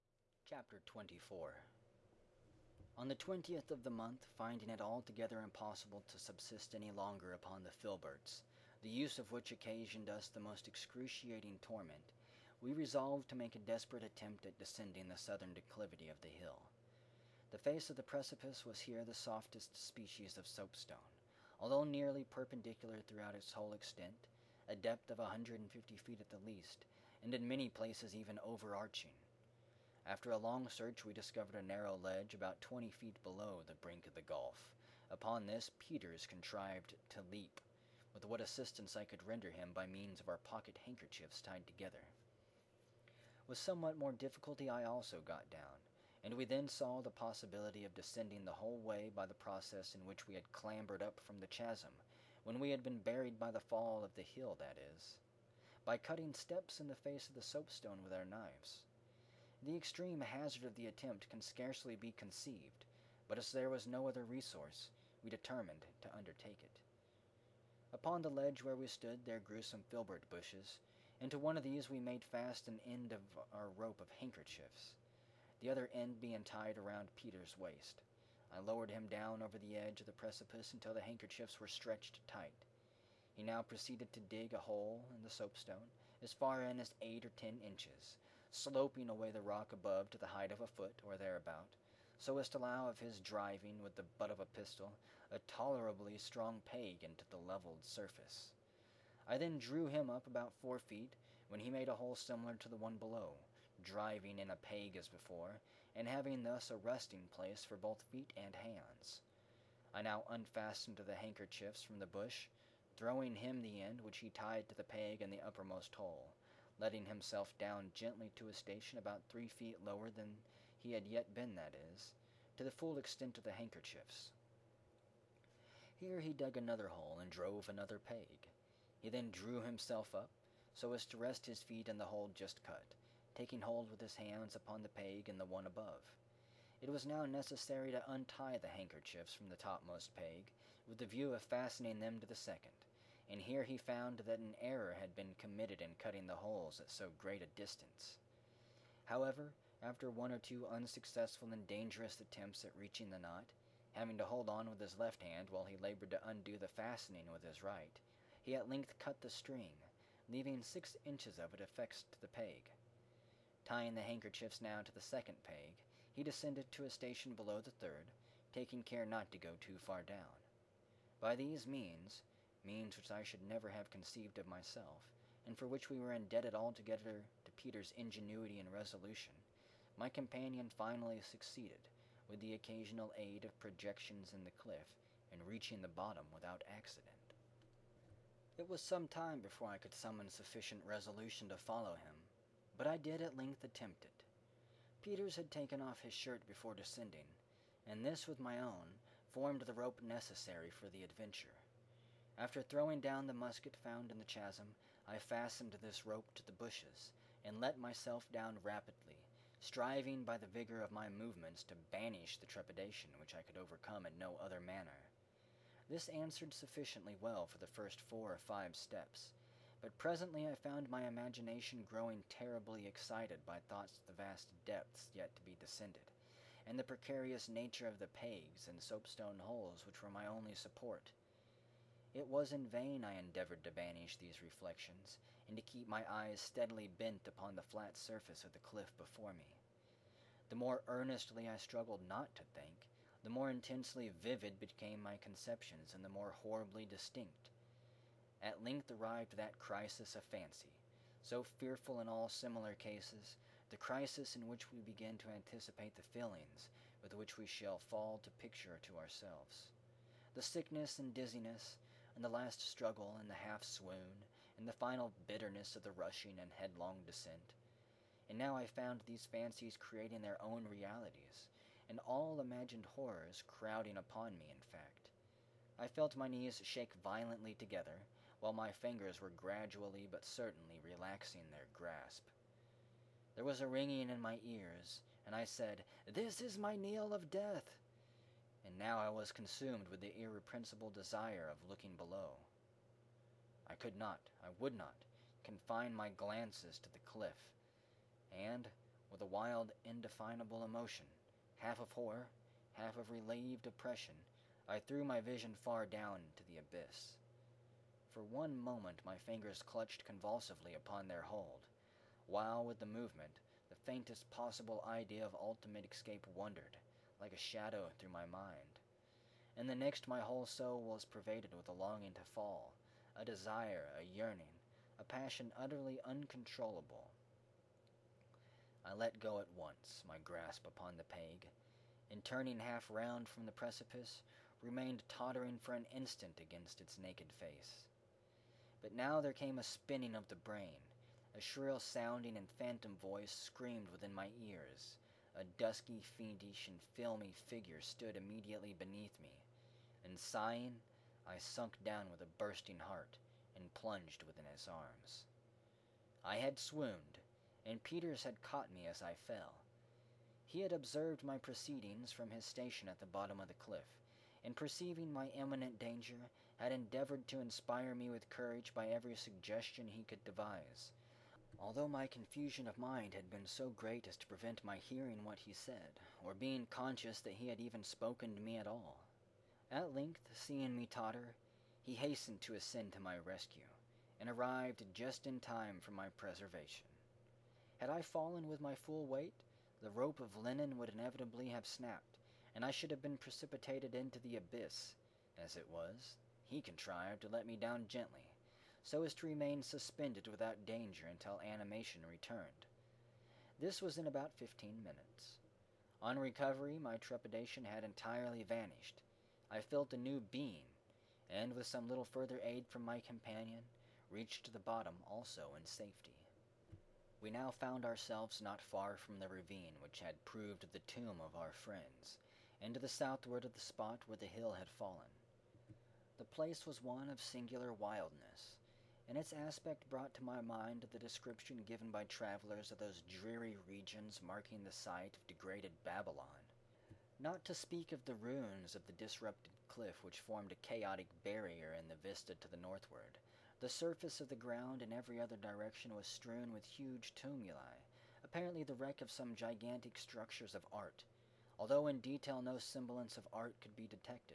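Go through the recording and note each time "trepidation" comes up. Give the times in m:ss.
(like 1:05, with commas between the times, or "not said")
3:32, 6:46.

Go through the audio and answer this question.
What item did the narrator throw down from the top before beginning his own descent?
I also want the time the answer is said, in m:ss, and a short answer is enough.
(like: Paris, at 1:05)
the musket, at 3:23.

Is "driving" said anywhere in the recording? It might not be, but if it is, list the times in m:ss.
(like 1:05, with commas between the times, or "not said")
1:33, 1:43.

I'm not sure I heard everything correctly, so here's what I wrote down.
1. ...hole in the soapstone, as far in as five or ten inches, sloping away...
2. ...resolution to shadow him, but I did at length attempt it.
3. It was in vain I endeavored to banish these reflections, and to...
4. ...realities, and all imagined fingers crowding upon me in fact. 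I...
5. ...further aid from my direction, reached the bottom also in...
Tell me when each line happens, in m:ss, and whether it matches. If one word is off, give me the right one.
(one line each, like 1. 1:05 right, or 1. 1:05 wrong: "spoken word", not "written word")
1. 1:24 wrong: "eight", not "five"
2. 3:10 wrong: "follow", not "shadow"
3. 3:52 right
4. 4:30 wrong: "horrors", not "fingers"
5. 6:52 wrong: "companion", not "direction".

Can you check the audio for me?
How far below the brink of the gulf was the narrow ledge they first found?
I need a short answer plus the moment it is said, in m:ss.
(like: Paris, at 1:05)
20 feet, at 0:32.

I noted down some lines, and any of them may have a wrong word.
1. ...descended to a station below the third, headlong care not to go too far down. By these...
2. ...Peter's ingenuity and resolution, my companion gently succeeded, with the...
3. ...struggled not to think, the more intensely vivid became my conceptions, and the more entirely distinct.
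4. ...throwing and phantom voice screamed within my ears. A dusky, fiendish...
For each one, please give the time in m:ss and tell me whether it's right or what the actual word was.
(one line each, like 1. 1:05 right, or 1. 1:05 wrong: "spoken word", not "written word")
1. 2:46 wrong: "taking", not "headlong"
2. 2:57 wrong: "finally", not "gently"
3. 4:01 wrong: "horribly", not "entirely"
4. 5:41 wrong: "sounding", not "throwing".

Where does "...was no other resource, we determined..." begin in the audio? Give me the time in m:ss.
1:03.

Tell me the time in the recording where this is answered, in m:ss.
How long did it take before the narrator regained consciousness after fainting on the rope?
6:44.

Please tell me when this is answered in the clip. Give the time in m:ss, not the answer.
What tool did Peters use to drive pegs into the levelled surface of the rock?
1:34.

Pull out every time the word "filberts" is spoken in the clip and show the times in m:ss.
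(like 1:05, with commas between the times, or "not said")
0:07, 1:09.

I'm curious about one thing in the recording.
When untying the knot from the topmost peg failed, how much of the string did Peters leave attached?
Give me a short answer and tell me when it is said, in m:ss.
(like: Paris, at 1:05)
6 inches, at 2:40.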